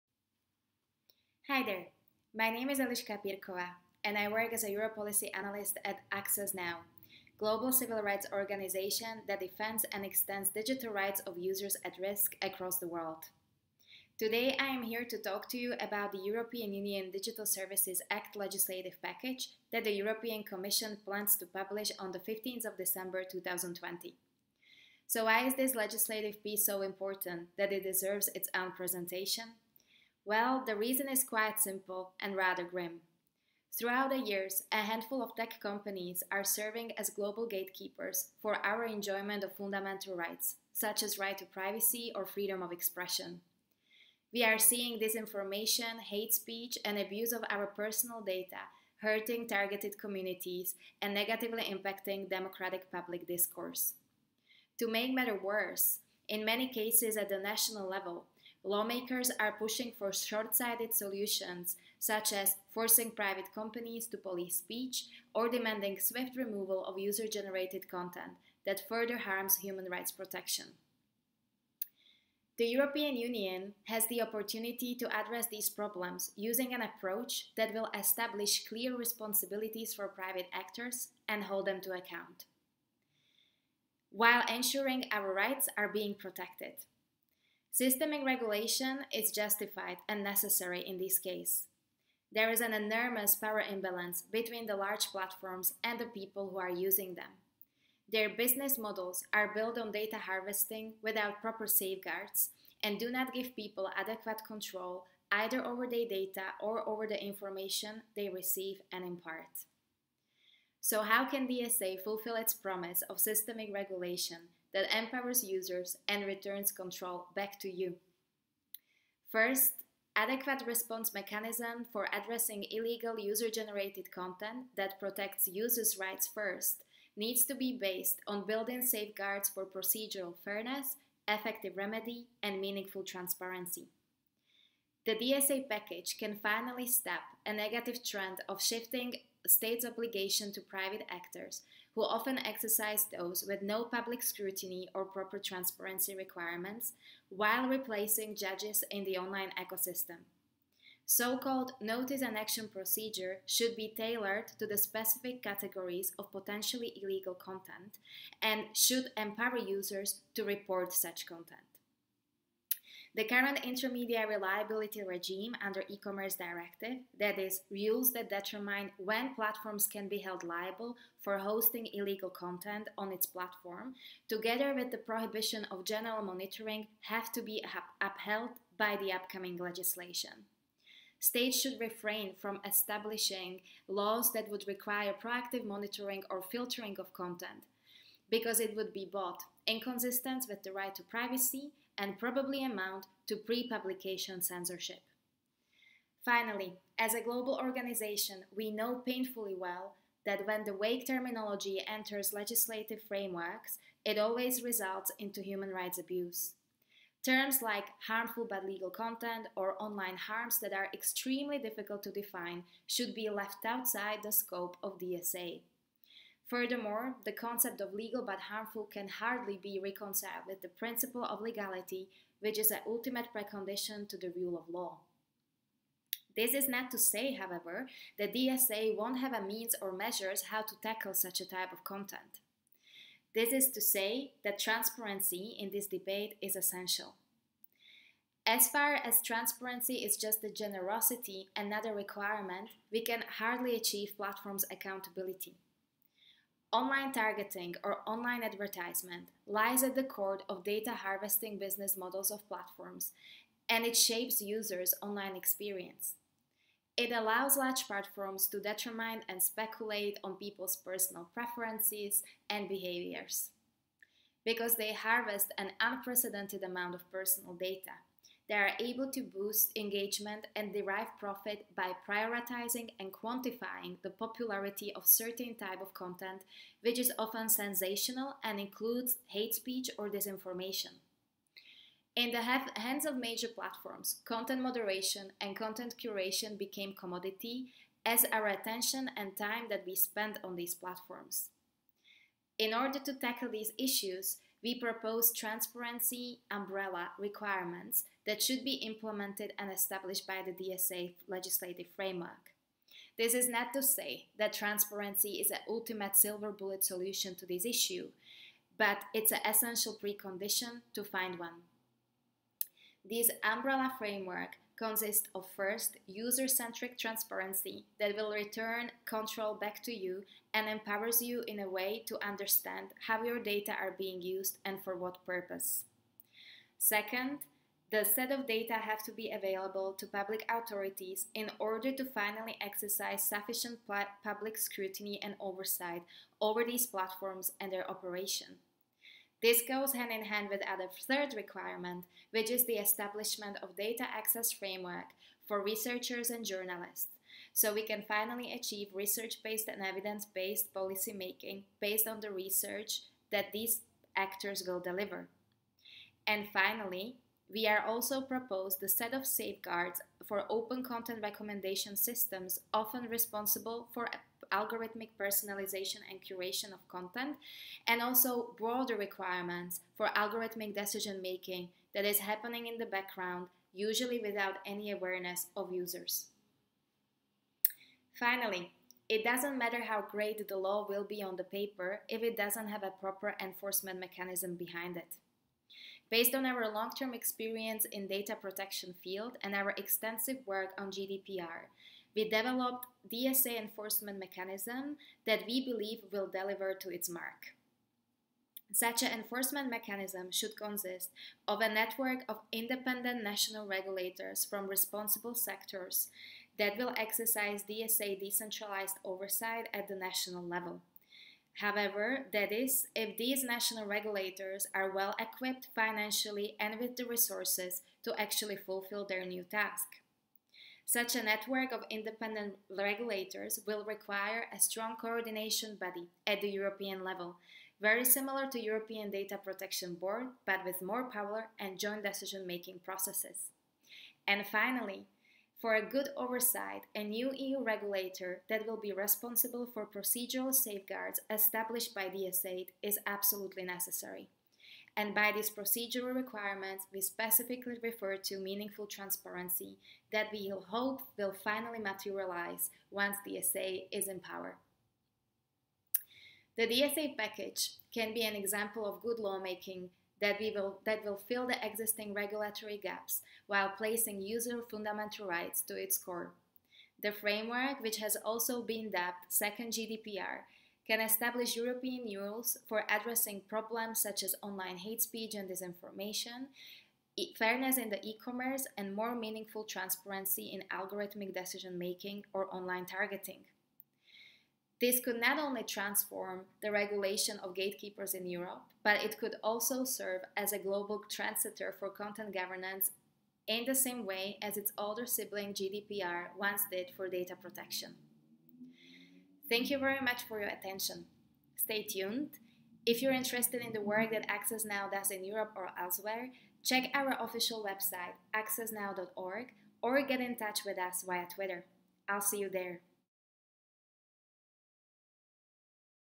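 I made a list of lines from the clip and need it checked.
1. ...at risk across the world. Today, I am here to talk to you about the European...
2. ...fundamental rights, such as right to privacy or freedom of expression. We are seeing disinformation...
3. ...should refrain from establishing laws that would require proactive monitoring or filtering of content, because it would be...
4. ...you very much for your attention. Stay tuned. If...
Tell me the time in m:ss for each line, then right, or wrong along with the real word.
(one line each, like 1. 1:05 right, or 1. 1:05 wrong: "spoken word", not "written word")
1. 0:11 right
2. 0:39 right
3. 3:01 right
4. 8:19 right.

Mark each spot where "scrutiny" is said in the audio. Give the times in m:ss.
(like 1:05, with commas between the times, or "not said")
2:24, 5:34.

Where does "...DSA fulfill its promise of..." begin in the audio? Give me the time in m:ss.
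1:51.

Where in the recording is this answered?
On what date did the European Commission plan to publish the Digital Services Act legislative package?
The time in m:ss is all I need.
0:22.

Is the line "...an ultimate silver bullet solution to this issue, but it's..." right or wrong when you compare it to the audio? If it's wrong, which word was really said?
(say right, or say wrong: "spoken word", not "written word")
right.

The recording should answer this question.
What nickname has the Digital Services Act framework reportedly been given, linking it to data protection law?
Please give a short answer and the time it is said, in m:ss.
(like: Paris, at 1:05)
Second GDPR, at 7:49.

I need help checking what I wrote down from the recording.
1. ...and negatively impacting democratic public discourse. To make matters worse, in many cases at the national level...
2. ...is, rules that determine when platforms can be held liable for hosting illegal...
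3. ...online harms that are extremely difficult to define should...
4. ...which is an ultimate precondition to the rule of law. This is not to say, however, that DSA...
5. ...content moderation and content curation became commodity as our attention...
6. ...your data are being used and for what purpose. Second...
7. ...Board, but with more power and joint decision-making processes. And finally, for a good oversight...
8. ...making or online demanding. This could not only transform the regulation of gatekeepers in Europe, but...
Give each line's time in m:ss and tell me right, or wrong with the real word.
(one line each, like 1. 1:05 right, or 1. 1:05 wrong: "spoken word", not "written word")
1. 0:51 right
2. 2:47 right
3. 3:29 right
4. 3:42 right
5. 4:44 right
6. 5:23 right
7. 7:09 right
8. 8:01 wrong: "targeting", not "demanding".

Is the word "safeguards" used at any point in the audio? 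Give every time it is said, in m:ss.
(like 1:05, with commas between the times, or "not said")
1:41, 2:08, 5:59, 7:20.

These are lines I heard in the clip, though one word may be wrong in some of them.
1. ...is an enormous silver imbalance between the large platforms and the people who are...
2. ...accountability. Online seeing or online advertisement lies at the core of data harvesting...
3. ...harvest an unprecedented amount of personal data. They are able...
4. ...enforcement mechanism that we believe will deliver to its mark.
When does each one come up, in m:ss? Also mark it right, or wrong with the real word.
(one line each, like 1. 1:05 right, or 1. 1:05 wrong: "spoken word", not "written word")
1. 1:32 wrong: "power", not "silver"
2. 4:04 wrong: "targeting", not "seeing"
3. 4:24 right
4. 6:33 right.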